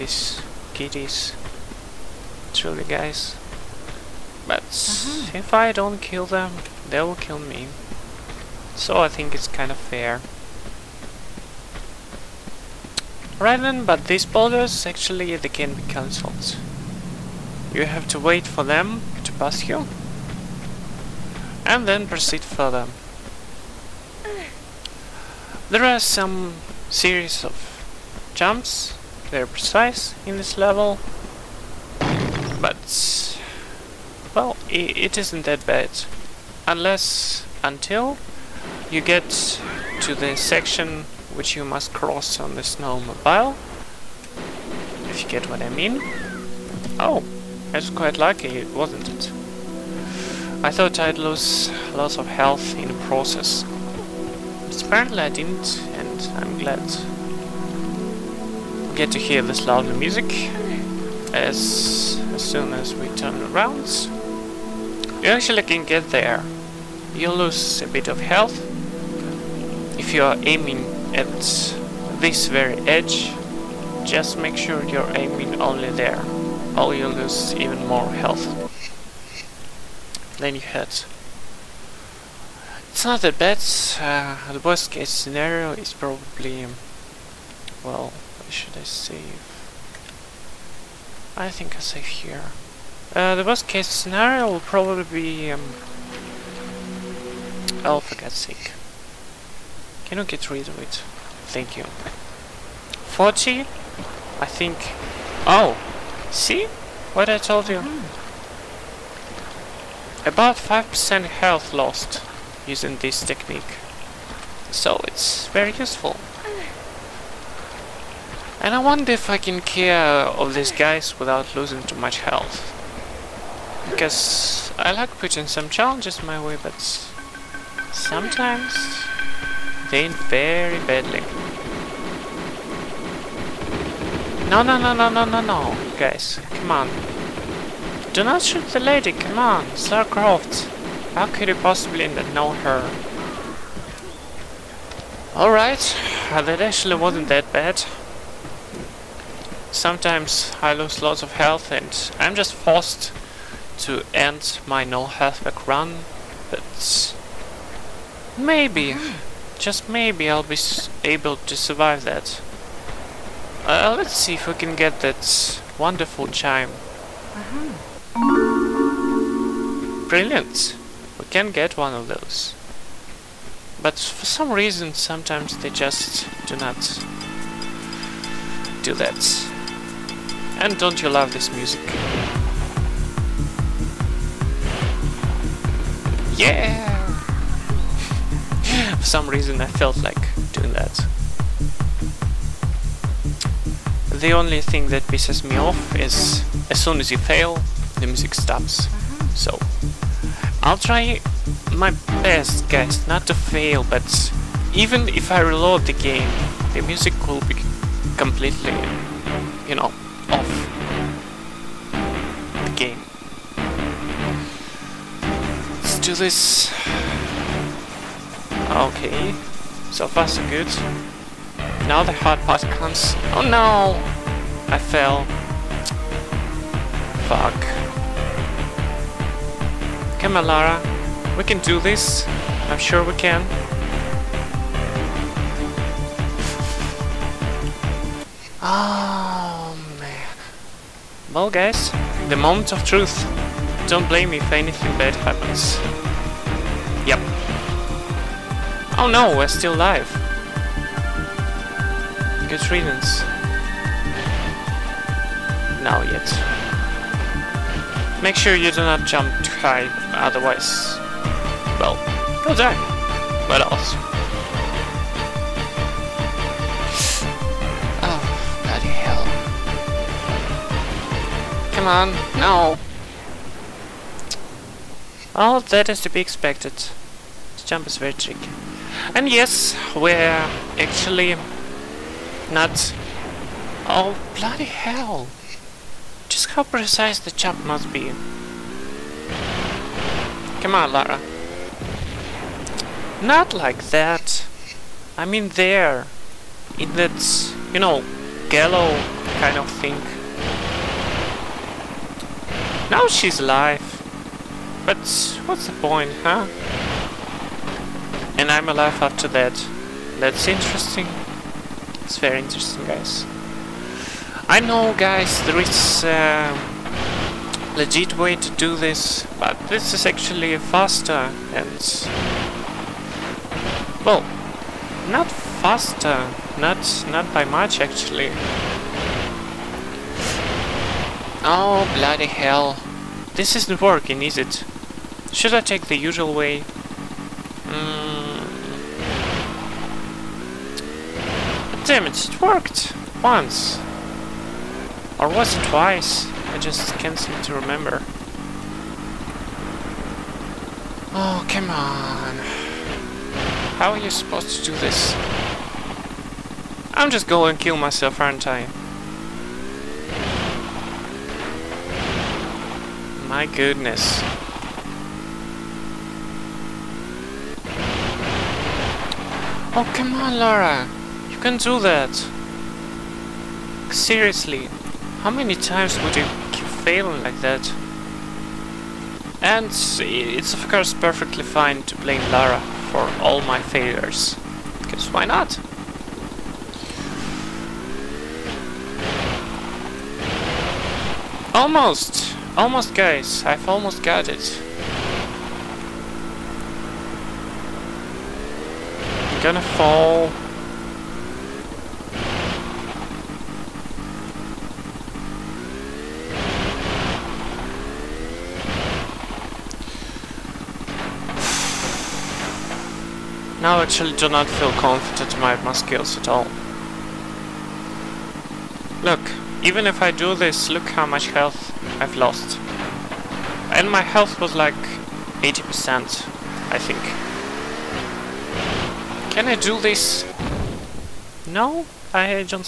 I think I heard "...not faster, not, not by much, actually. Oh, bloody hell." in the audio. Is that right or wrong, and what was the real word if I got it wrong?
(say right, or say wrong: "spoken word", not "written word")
right.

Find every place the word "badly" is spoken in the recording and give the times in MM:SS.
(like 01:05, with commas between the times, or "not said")
02:10.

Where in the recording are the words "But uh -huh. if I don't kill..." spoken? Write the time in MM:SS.
00:04.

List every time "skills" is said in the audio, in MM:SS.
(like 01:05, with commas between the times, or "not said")
06:55.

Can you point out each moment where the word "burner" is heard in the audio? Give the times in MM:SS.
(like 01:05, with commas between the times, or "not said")
not said.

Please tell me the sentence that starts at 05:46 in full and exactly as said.
I just can't seem to remember.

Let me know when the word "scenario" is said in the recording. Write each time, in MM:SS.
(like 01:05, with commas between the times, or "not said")
01:25, 01:33.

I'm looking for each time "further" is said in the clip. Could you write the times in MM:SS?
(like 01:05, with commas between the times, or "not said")
00:22.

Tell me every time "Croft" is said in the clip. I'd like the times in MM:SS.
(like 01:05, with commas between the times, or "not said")
02:20.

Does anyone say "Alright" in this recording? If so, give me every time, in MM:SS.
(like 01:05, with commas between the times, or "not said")
02:25.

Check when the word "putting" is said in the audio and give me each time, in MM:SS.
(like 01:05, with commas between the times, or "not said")
02:05.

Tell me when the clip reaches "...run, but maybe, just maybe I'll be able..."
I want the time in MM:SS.
02:35.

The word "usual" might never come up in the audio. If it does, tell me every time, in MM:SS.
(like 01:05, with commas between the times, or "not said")
05:35.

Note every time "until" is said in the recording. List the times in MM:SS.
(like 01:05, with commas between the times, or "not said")
00:37.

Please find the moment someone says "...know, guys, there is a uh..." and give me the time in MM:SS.
05:14.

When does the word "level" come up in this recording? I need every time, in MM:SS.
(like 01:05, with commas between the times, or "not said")
00:30.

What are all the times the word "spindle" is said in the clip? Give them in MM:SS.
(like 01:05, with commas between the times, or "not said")
not said.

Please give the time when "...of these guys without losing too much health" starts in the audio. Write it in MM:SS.
02:00.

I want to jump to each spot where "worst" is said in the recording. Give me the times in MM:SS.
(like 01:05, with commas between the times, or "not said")
01:24, 01:33.